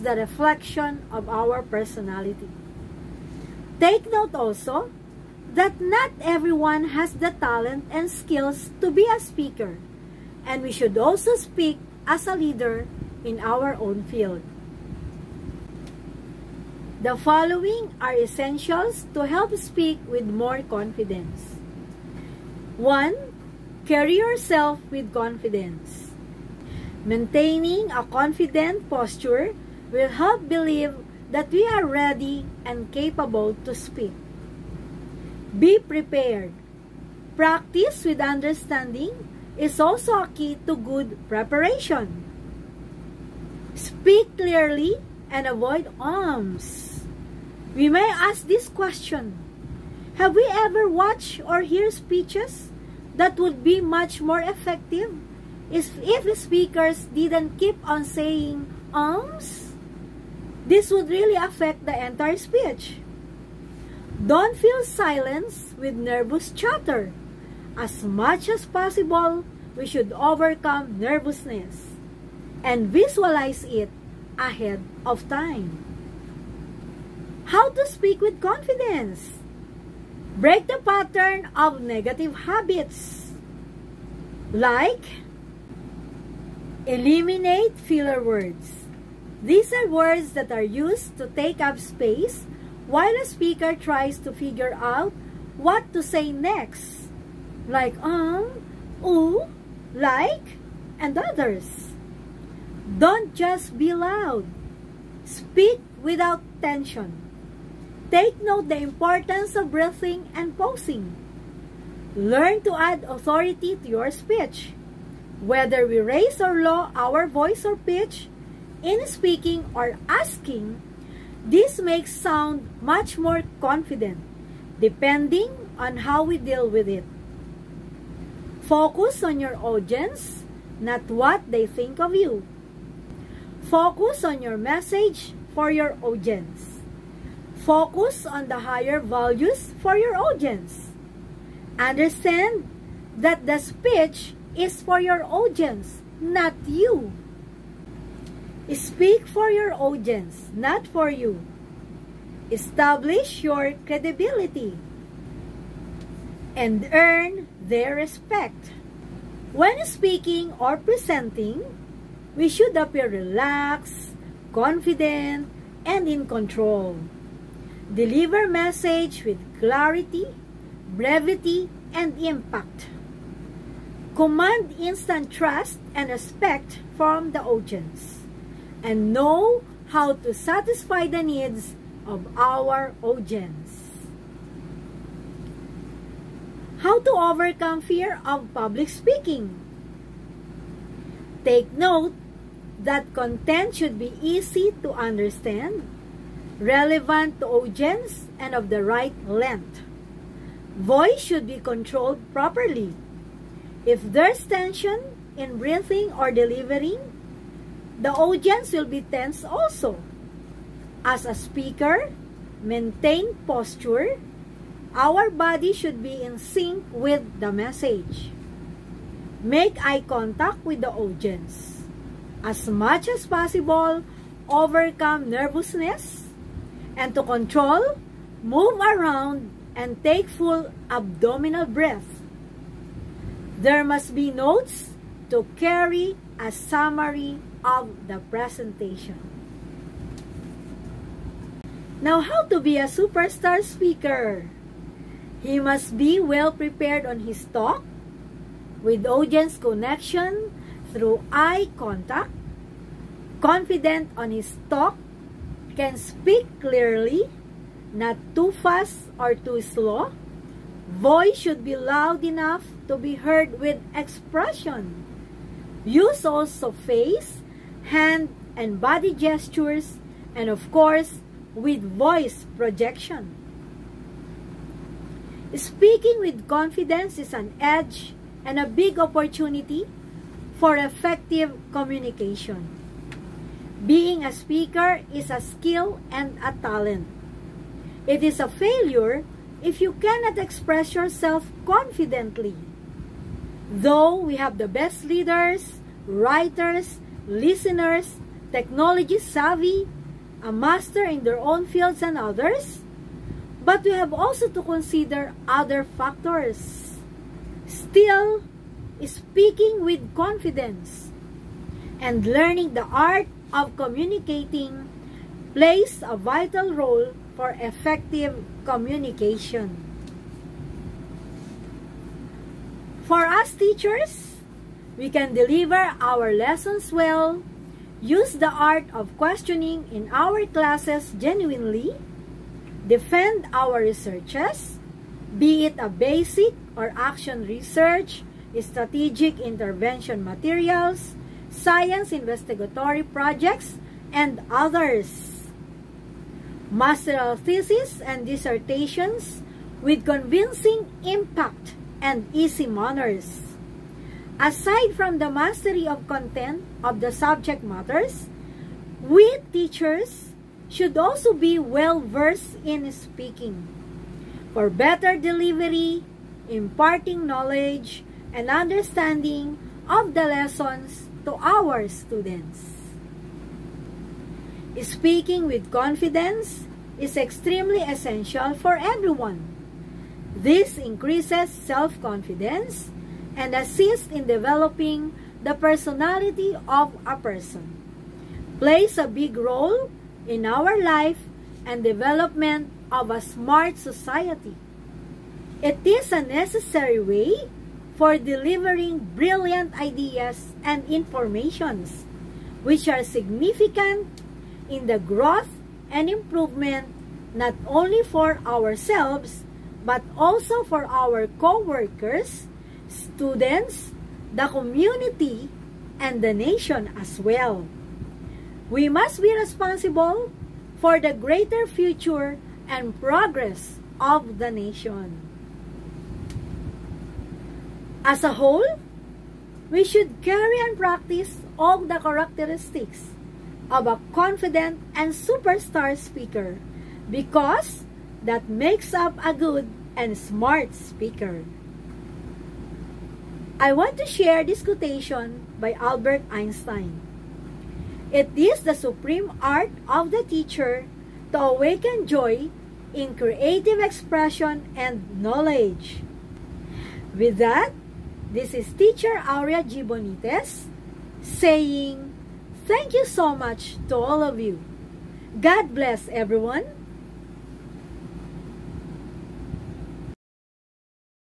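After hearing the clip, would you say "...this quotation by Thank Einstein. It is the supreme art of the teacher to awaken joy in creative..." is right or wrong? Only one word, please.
wrong.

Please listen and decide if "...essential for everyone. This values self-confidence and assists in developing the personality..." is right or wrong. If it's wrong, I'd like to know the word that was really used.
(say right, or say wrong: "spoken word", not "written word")
wrong: "increases", not "values".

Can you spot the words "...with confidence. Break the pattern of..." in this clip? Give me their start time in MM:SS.
01:18.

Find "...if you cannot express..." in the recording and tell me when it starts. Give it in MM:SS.
04:49.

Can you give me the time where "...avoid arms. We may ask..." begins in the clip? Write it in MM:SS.
00:45.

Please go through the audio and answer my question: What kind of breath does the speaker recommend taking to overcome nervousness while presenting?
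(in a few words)
Full abdominal breath.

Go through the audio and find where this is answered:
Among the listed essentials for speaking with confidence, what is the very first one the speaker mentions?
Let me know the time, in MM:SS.
00:23.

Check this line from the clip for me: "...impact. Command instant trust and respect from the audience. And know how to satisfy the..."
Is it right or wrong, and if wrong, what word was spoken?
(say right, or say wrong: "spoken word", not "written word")
right.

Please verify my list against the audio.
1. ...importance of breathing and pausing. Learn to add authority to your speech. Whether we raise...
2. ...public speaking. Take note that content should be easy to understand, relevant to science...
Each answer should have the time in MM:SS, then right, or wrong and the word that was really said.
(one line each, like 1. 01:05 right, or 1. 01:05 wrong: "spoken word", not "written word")
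1. 01:48 right
2. 03:08 wrong: "audience", not "science".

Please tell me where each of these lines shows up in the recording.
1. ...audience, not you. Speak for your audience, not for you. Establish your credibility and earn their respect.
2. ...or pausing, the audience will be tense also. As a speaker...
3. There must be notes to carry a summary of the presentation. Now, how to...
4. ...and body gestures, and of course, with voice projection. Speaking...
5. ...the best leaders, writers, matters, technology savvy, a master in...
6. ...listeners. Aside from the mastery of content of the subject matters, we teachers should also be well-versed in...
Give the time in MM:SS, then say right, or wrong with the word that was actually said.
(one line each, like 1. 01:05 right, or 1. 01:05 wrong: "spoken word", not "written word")
1. 02:25 right
2. 03:26 wrong: "delivering", not "pausing"
3. 03:53 right
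4. 04:28 right
5. 04:54 wrong: "listeners", not "matters"
6. 05:52 wrong: "manners", not "listeners".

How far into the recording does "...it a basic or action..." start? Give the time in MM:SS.
05:35.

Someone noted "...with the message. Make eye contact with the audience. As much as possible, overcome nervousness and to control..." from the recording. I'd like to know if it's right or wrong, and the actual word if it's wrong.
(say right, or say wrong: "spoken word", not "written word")
right.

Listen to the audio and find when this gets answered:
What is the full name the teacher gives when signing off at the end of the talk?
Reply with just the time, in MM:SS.
07:39.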